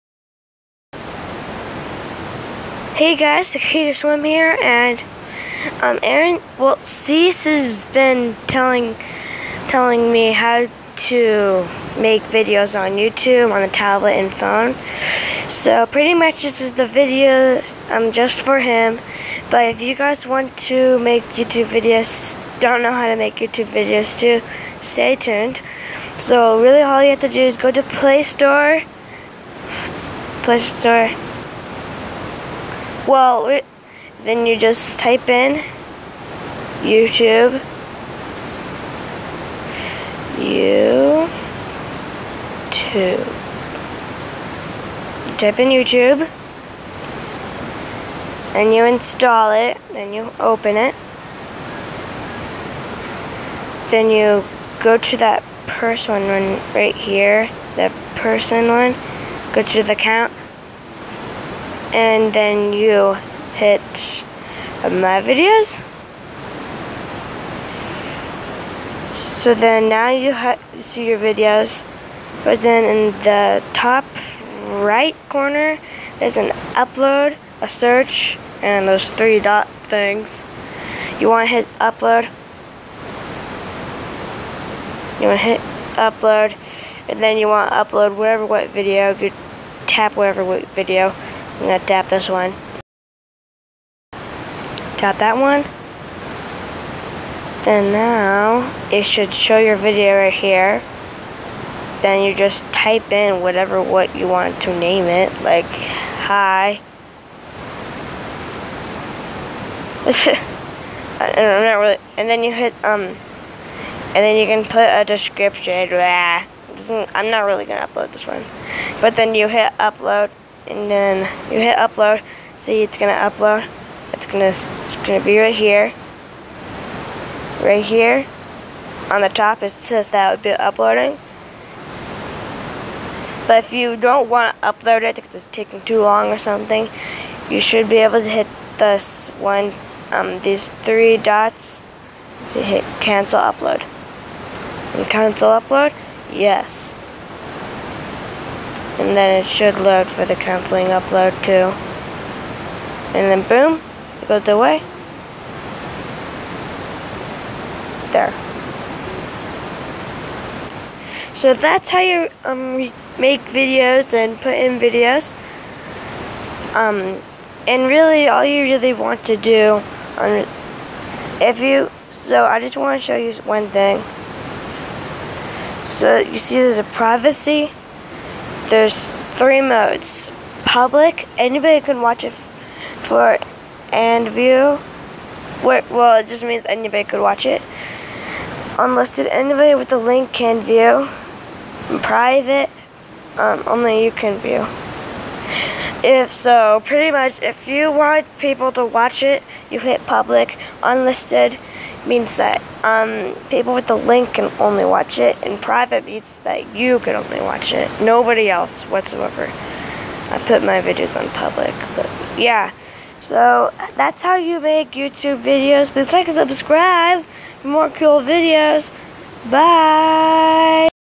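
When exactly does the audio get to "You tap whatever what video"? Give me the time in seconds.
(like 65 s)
89 s.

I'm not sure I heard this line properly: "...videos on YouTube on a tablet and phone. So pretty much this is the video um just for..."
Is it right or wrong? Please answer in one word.
right.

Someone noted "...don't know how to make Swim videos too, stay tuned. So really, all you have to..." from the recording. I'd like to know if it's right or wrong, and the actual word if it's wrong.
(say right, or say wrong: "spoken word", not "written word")
wrong: "YouTube", not "Swim".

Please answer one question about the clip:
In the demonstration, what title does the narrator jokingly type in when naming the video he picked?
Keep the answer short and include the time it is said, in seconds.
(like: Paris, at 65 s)
hi, at 106 s.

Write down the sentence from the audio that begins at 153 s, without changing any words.
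And then boom, it goes away.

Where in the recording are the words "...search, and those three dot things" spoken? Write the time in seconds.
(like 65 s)
77 s.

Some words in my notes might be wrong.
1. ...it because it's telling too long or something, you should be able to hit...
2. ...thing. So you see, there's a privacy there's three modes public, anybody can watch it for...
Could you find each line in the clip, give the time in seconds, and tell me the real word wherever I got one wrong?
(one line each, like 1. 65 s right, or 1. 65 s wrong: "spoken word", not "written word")
1. 135 s wrong: "taking", not "telling"
2. 173 s right.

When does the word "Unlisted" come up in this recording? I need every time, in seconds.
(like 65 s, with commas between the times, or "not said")
188 s, 200 s.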